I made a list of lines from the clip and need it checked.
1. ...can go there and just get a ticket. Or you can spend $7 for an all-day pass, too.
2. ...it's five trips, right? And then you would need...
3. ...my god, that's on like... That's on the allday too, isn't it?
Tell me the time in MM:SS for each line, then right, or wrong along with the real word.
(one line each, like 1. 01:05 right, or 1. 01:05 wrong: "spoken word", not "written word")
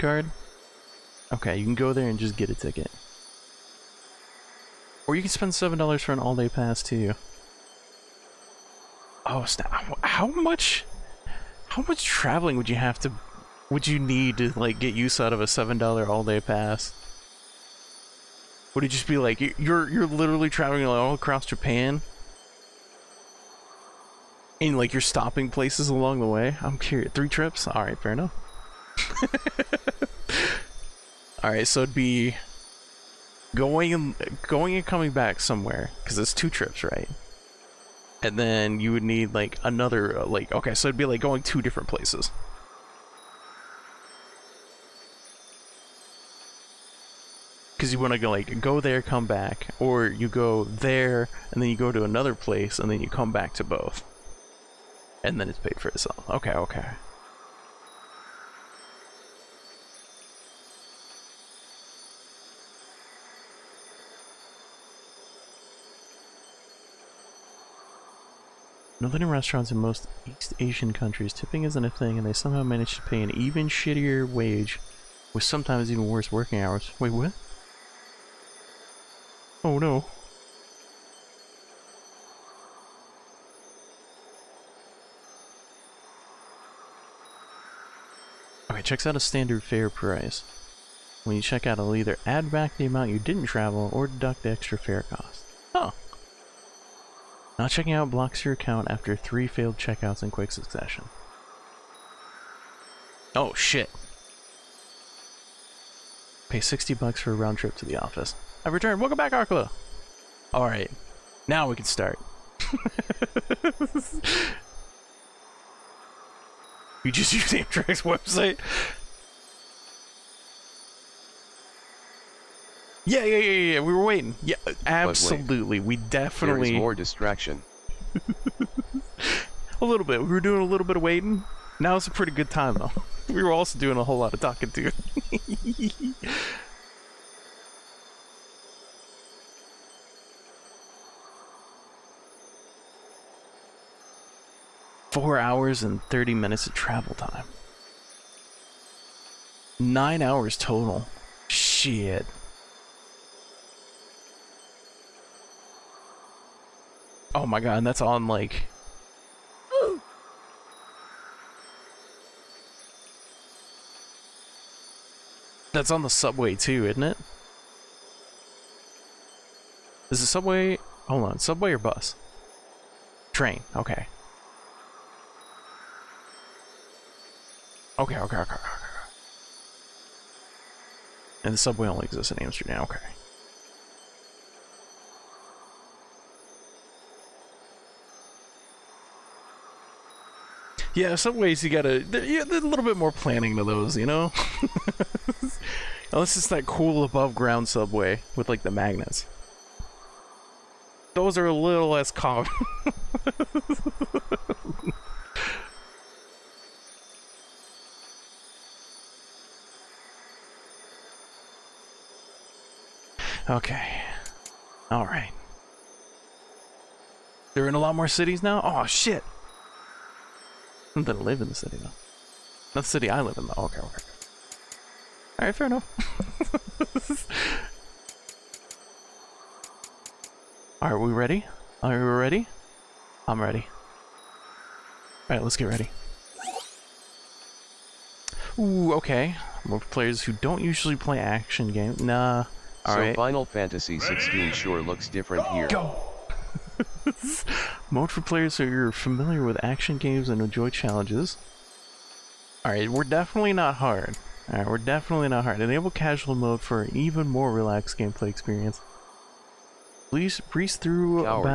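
1. 00:01 right
2. 00:36 wrong: "two", not "five"
3. 02:37 wrong: "subway", not "allday".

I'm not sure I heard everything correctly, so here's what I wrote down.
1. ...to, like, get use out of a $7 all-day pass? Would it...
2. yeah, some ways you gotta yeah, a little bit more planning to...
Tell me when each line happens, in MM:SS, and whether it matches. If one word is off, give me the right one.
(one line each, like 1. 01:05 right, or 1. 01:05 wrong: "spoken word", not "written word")
1. 00:14 right
2. 03:10 right.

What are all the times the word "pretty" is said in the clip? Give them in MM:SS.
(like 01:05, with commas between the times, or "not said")
02:12.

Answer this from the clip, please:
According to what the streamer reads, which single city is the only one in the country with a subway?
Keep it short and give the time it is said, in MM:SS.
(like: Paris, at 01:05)
Amsterdam, at 03:02.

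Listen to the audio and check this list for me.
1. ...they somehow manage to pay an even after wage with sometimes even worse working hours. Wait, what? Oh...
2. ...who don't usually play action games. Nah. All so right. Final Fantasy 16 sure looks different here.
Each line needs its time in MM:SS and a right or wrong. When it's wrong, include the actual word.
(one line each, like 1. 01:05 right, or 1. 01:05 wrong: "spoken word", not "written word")
1. 01:12 wrong: "shittier", not "after"
2. 04:00 right.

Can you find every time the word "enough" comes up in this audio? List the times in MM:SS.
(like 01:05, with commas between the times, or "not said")
00:28, 03:45.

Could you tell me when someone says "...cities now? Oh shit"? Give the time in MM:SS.
03:38.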